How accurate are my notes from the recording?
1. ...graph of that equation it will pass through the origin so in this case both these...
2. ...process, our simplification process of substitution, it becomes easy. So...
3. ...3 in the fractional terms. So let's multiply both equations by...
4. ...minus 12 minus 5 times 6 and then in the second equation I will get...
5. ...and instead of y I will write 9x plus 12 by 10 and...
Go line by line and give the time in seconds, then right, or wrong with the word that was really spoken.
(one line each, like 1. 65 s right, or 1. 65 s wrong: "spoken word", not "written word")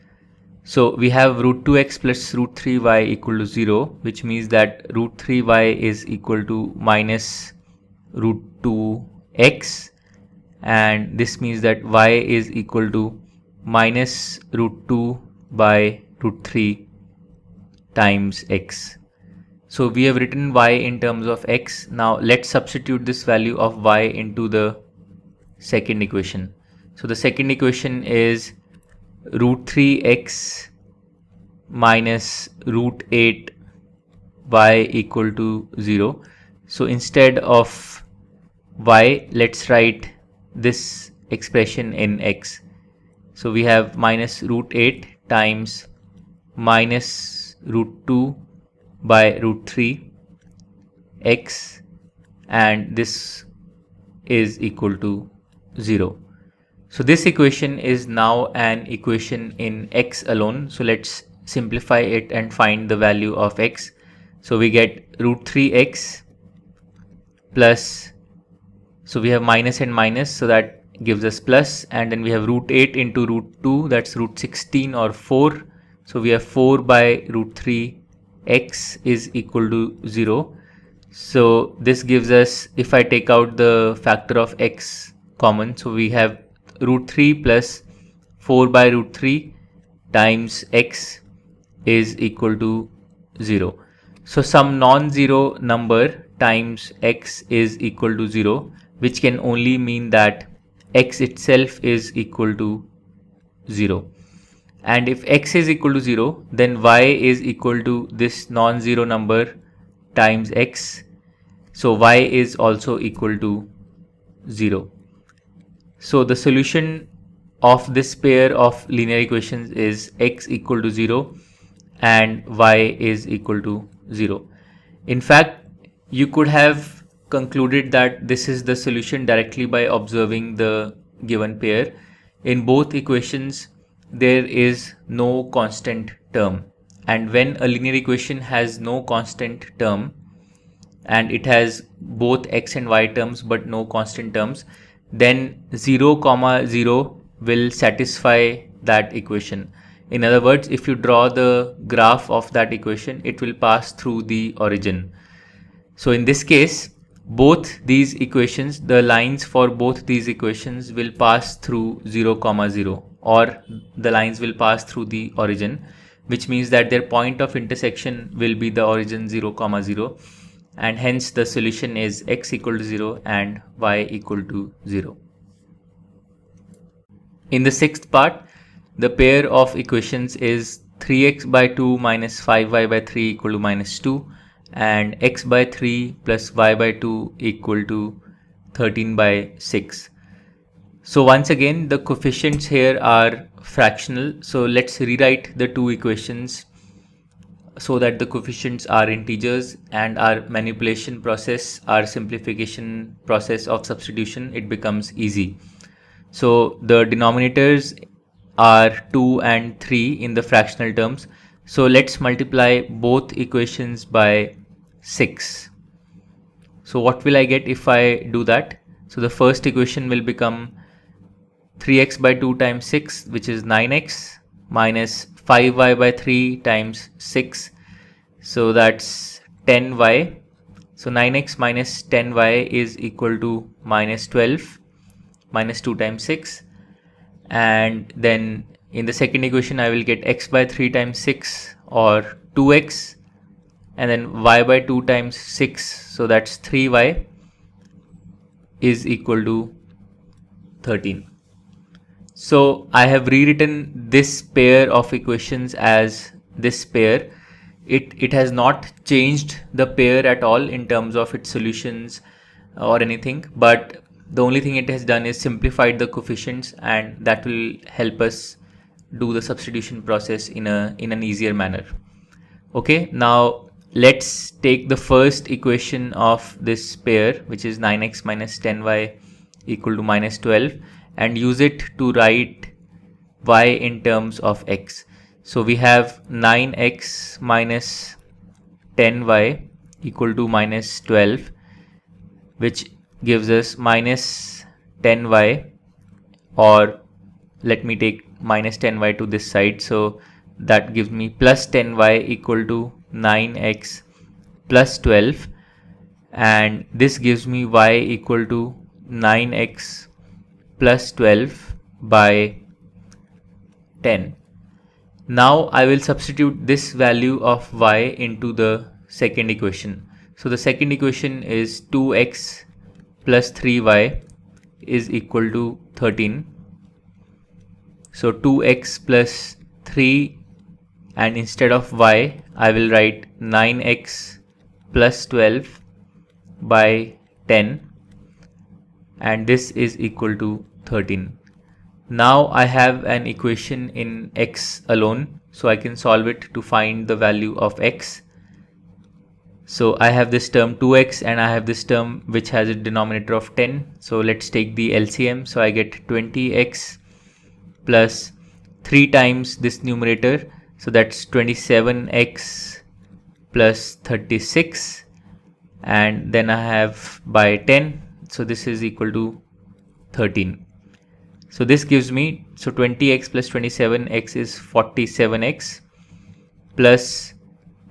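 1. 151 s right
2. 201 s right
3. 209 s right
4. 233 s wrong: "2", not "5"
5. 331 s right.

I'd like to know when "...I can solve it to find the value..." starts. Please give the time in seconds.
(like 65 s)
345 s.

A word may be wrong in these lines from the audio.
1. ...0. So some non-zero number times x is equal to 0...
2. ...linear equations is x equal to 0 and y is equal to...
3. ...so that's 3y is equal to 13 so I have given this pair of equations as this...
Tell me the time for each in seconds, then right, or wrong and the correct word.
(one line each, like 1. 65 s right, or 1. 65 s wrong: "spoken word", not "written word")
1. 93 s right
2. 118 s right
3. 246 s wrong: "rewritten", not "given".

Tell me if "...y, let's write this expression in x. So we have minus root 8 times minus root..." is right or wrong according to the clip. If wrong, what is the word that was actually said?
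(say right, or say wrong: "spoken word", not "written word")
right.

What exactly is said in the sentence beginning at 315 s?
Now I will substitute this value of y into the second equation.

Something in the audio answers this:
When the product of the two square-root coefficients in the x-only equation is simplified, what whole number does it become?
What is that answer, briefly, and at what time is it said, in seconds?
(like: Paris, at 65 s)
4, at 74 s.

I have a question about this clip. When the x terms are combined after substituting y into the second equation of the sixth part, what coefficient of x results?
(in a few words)
47.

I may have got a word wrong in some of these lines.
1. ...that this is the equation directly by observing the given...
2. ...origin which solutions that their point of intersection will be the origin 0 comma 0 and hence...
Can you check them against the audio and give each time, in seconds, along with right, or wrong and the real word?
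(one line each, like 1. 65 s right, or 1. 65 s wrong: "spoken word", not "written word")
1. 127 s wrong: "solution", not "equation"
2. 165 s wrong: "means", not "solutions".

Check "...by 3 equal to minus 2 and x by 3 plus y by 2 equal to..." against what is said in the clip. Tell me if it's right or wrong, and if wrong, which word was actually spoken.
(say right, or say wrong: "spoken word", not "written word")
right.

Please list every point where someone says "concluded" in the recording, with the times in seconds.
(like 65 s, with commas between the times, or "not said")
127 s.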